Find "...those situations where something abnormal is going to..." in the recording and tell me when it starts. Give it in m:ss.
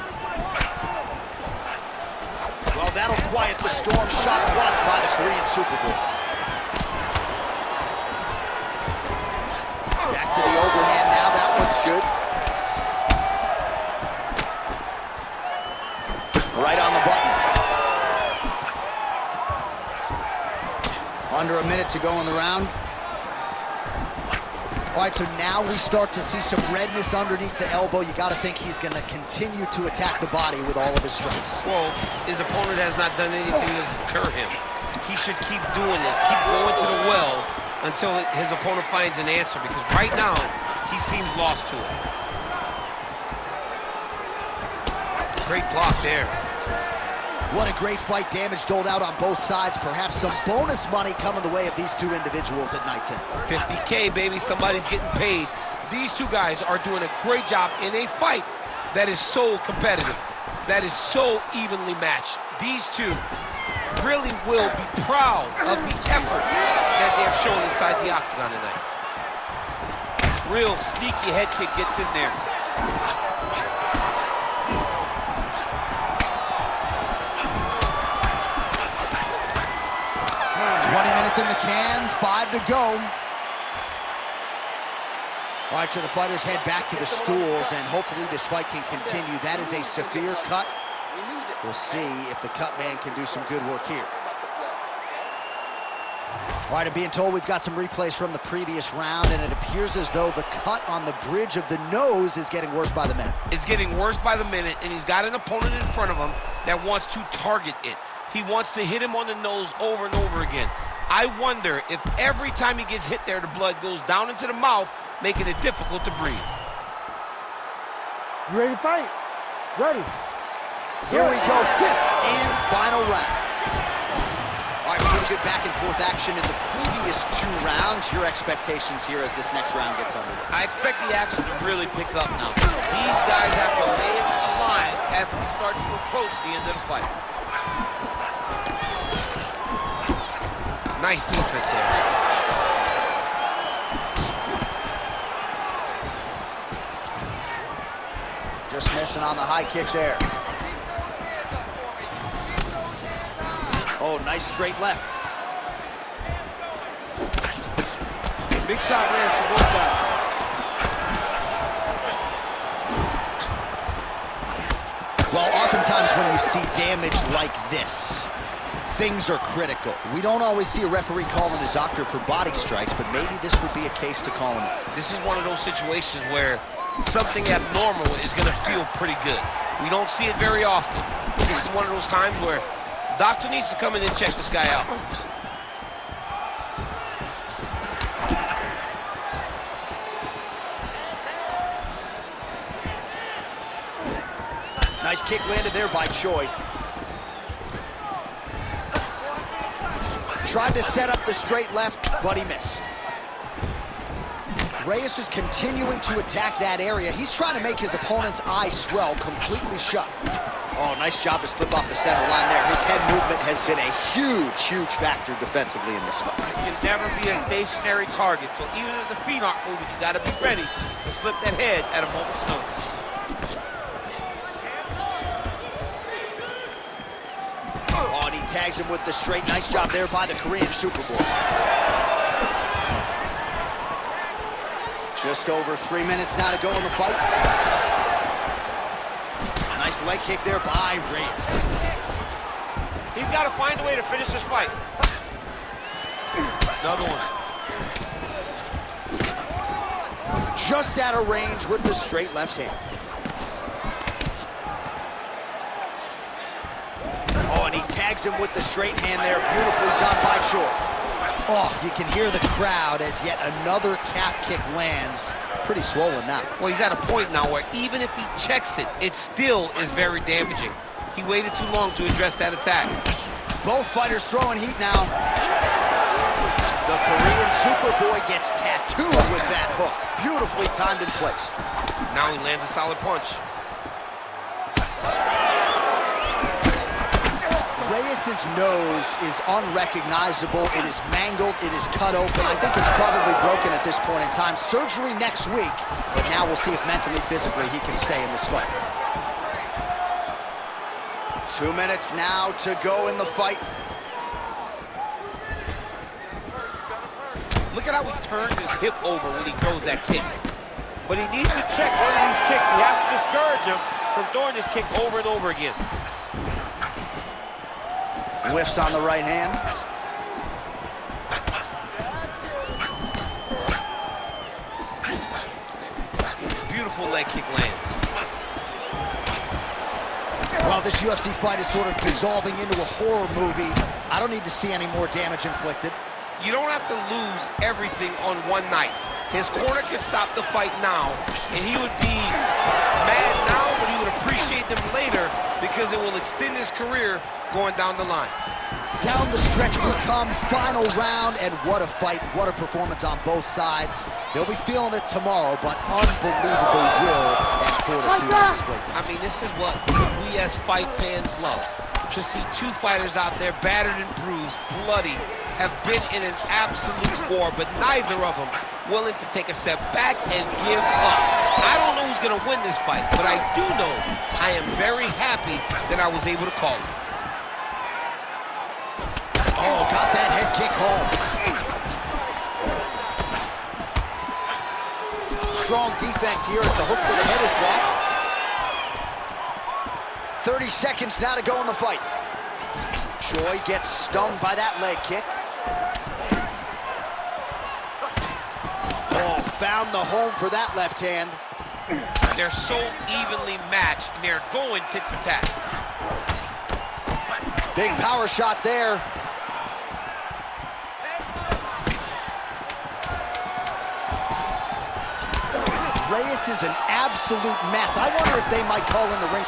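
2:55.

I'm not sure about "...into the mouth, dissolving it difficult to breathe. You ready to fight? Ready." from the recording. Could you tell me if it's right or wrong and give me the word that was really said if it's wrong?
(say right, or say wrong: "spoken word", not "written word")
wrong: "making", not "dissolving".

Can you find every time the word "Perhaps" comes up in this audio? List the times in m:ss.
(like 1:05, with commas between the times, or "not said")
0:49.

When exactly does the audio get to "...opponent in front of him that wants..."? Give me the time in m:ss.
1:45.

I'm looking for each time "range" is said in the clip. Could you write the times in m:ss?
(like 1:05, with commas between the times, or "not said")
4:11.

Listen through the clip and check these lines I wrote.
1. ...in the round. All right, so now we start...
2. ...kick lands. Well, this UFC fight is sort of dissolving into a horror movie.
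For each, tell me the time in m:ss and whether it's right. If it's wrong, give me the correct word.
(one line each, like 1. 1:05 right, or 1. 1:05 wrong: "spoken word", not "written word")
1. 0:22 right
2. 5:27 right.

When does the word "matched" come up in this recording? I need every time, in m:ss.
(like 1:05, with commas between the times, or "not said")
1:01, 6:43.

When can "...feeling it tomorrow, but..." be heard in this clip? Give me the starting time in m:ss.
5:54.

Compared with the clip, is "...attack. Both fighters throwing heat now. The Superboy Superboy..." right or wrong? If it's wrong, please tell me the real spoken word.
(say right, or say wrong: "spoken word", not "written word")
wrong: "Korean", not "Superboy".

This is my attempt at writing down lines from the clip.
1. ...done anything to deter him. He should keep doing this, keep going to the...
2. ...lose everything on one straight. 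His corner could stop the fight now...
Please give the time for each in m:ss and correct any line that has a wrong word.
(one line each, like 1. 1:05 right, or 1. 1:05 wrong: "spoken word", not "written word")
1. 0:33 right
2. 5:37 wrong: "night", not "straight".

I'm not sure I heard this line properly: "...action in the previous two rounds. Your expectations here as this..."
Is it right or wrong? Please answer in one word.
right.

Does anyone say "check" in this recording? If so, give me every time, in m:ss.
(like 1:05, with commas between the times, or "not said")
3:04, 4:28, 5:11.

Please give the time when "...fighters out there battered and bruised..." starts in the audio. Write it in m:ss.
6:02.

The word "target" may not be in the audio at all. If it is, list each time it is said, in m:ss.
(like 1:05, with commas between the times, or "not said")
1:47, 3:38.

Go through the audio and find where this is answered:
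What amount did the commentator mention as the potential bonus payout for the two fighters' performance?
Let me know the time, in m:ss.
0:53.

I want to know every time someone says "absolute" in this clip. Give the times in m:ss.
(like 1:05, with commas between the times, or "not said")
6:06, 6:56.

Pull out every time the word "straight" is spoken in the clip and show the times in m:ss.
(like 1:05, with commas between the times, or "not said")
2:34, 3:21, 3:49, 4:11, 4:18.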